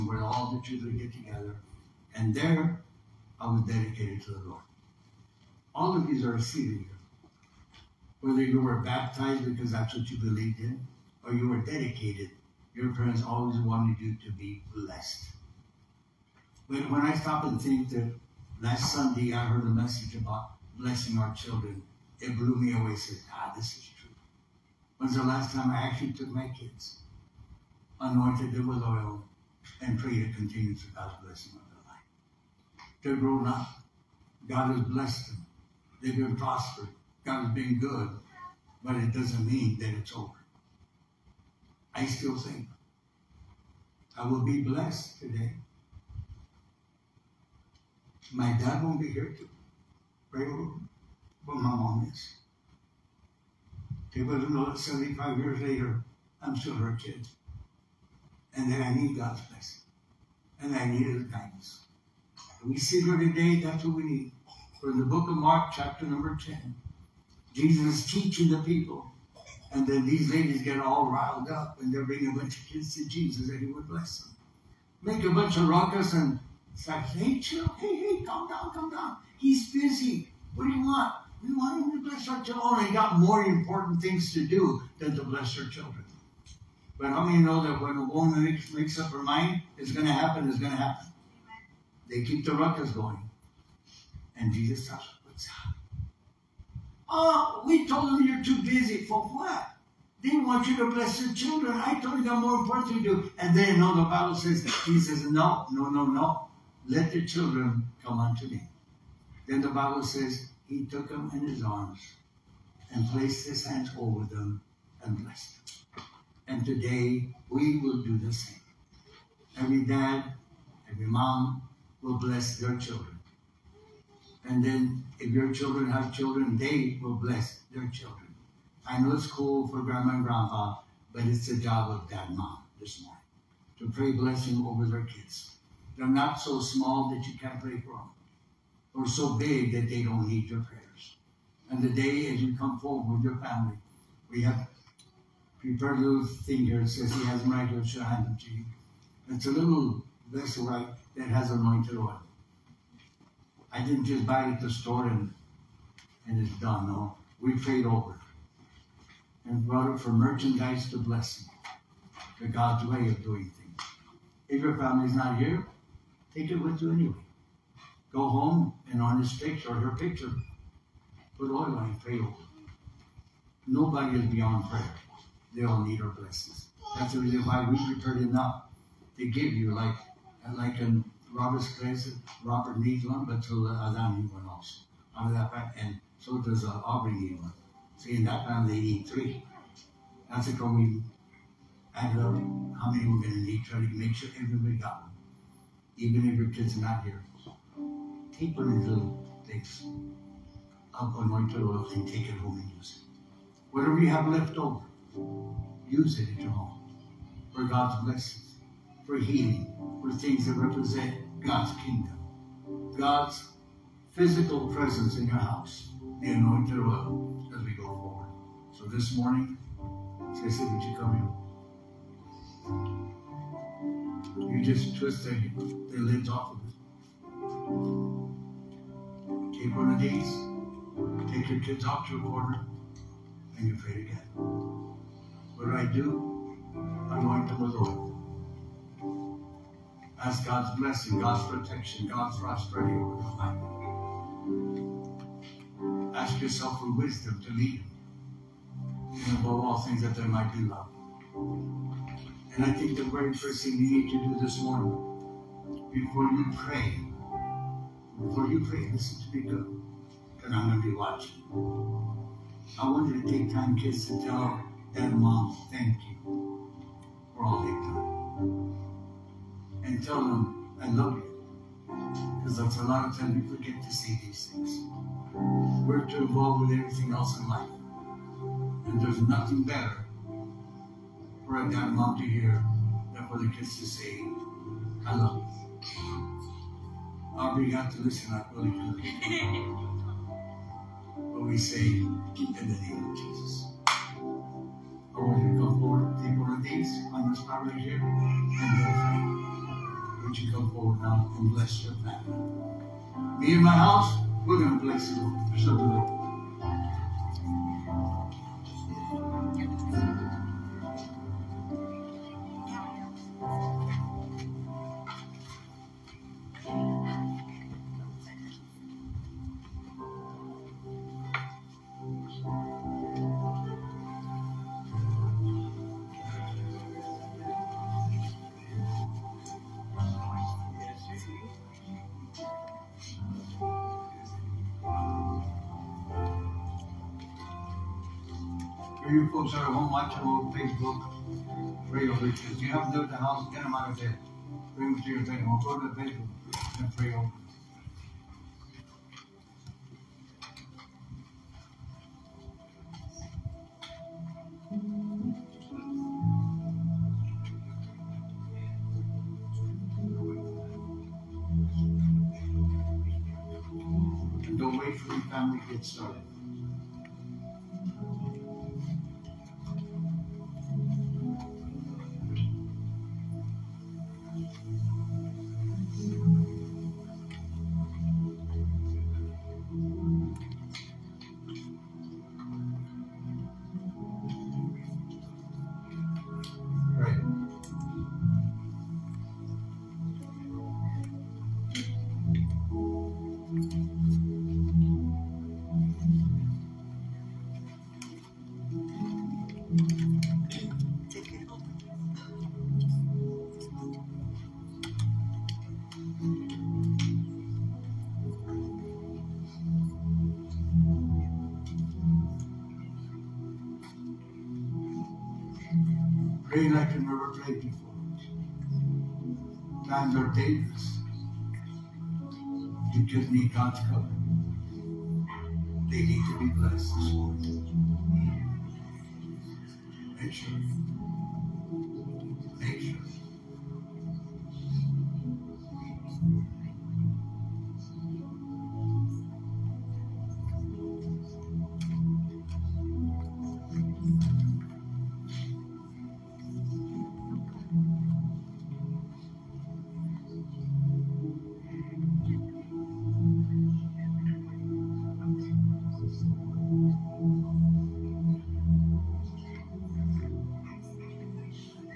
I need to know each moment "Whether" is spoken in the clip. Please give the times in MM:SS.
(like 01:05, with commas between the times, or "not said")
00:08.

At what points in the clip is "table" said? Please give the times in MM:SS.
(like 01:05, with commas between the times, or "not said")
05:45.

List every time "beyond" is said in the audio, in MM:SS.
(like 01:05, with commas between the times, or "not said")
02:54.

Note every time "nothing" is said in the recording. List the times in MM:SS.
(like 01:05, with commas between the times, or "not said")
04:39.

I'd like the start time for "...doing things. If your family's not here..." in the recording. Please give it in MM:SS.
02:43.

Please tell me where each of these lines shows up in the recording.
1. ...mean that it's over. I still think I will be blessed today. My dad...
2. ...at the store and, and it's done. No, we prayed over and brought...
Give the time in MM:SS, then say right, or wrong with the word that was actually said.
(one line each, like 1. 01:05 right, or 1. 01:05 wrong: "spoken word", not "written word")
1. 00:39 right
2. 02:34 right.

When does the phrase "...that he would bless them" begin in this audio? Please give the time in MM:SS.
01:13.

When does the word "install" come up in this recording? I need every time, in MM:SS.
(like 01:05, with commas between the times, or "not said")
not said.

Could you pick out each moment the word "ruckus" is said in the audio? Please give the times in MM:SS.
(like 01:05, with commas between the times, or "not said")
01:15, 01:32.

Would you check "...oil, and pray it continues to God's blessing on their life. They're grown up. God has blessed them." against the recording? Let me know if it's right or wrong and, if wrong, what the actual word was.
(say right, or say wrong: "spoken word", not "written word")
right.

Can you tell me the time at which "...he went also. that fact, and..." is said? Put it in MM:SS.
03:04.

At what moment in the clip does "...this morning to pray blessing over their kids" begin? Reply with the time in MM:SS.
02:12.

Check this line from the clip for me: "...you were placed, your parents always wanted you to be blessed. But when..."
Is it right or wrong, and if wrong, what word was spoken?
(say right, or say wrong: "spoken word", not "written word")
wrong: "dedicated", not "placed".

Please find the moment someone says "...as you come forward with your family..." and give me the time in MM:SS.
02:22.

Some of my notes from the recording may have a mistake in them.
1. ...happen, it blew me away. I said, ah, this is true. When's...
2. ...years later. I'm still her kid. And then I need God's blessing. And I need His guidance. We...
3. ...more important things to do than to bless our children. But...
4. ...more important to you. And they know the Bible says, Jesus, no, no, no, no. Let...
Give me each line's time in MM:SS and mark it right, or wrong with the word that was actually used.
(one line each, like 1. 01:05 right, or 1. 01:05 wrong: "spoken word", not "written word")
1. 00:21 wrong: "children", not "happen"
2. 00:55 right
3. 01:23 right
4. 01:42 right.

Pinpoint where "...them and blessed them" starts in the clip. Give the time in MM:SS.
01:54.